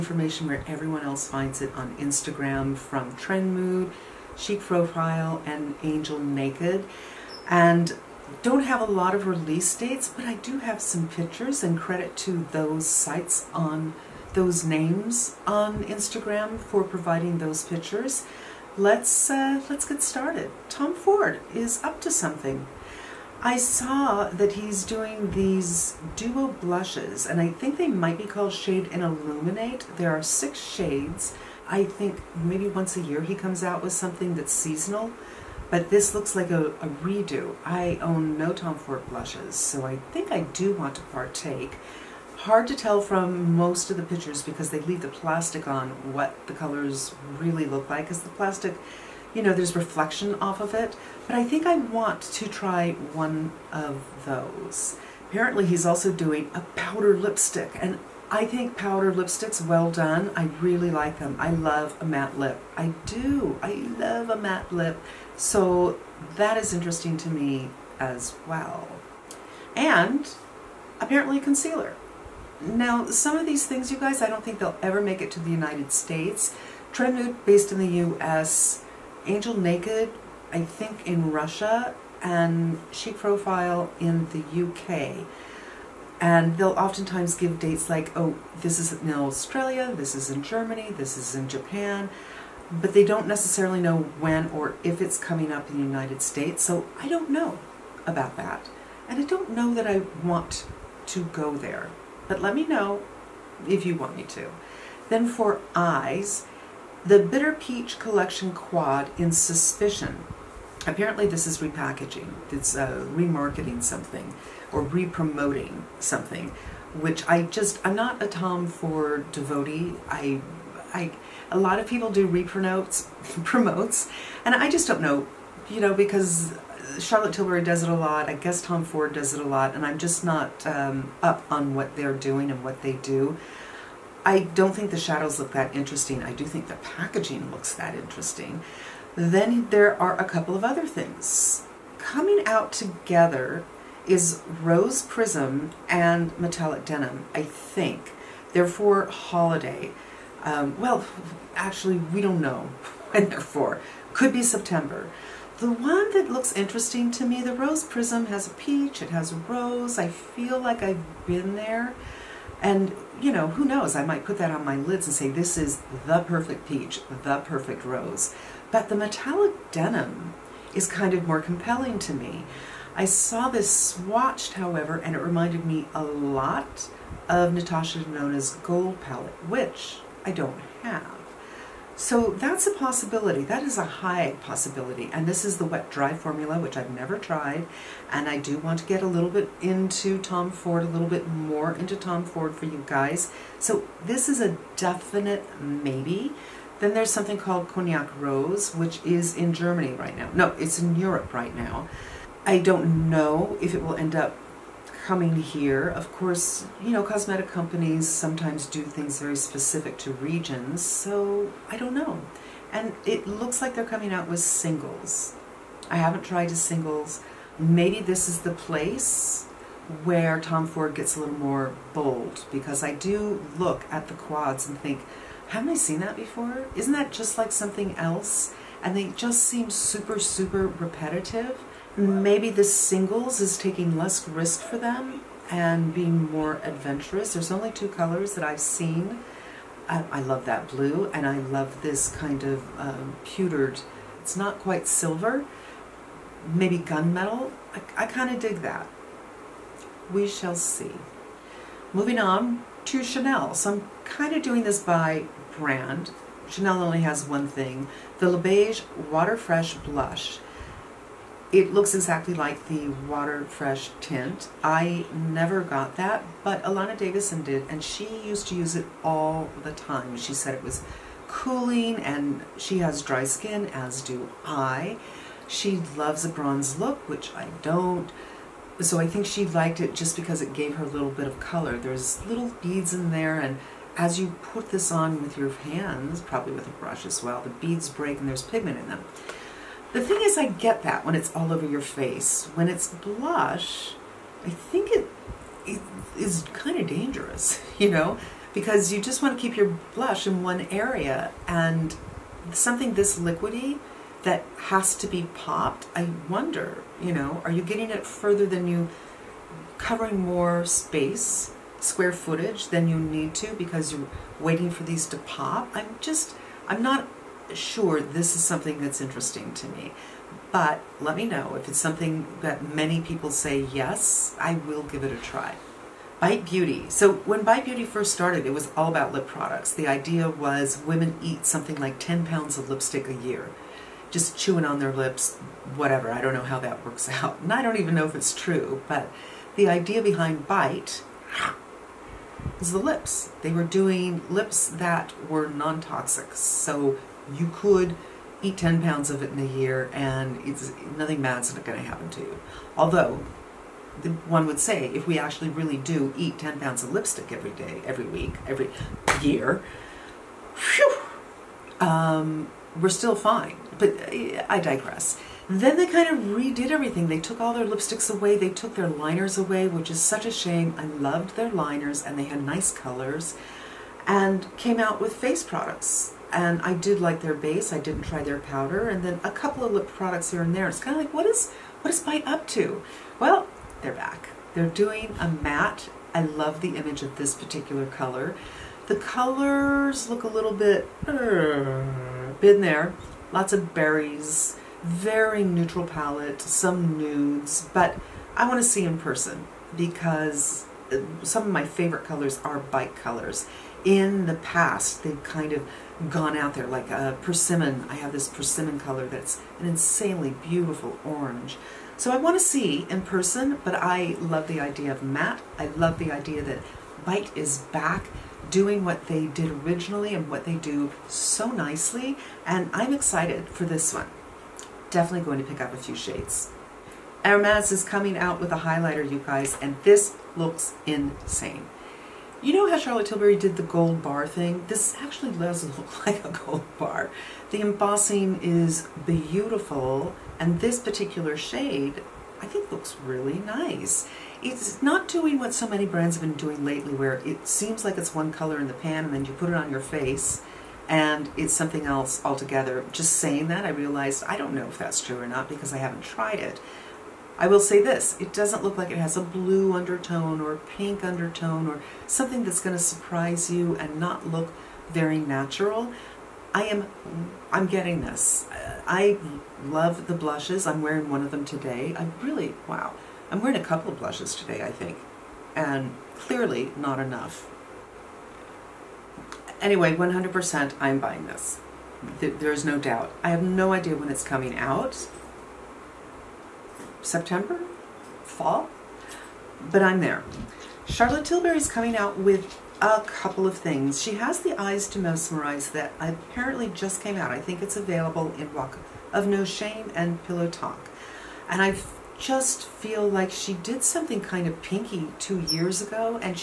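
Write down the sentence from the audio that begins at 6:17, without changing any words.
I didn't try their powder, and then a couple of lip products here and there.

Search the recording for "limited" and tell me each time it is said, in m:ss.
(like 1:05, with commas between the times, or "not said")
not said.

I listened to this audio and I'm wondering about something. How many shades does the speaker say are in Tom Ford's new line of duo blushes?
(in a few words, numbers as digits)
6.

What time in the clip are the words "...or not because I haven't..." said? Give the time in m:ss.
7:35.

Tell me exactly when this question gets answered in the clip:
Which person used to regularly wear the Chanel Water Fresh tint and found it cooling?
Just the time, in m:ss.
4:26.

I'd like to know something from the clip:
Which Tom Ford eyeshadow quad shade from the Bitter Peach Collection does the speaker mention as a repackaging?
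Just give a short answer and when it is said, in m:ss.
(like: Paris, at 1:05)
Suspicion, at 1:49.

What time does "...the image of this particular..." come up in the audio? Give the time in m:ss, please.
6:26.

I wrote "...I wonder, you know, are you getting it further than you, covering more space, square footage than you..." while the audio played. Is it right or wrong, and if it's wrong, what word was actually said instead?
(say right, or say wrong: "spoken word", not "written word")
right.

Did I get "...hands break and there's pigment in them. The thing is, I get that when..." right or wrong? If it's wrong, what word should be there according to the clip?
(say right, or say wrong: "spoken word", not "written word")
wrong: "beads", not "hands".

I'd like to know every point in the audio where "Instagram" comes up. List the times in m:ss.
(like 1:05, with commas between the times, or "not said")
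0:01, 0:15.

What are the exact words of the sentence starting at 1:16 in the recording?
Trend Mood, based in the U.S., Angel Naked, I think in Russia, and Chic Profile in the U.K.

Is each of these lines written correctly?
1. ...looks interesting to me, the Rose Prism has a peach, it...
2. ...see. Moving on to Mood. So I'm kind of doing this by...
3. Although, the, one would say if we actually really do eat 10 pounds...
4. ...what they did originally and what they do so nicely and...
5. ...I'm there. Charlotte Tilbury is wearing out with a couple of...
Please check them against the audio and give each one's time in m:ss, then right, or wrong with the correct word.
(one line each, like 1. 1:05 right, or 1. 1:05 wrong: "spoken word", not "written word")
1. 2:36 right
2. 4:10 wrong: "Chanel", not "Mood"
3. 5:52 right
4. 6:58 right
5. 8:09 wrong: "coming", not "wearing".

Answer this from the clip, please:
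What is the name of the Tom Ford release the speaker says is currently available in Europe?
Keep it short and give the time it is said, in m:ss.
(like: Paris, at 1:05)
Cognac Rose, at 3:17.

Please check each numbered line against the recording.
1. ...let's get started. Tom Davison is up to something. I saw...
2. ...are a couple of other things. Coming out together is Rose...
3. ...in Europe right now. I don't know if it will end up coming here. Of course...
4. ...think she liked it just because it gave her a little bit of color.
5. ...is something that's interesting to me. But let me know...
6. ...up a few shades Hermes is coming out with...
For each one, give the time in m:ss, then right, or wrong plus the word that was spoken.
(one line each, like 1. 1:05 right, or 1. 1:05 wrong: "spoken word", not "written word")
1. 0:19 wrong: "Ford", not "Davison"
2. 2:20 right
3. 3:20 right
4. 4:39 right
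5. 5:18 right
6. 7:05 right.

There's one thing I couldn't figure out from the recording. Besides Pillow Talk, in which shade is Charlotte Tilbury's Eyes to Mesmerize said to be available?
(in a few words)
Walk of No Shame.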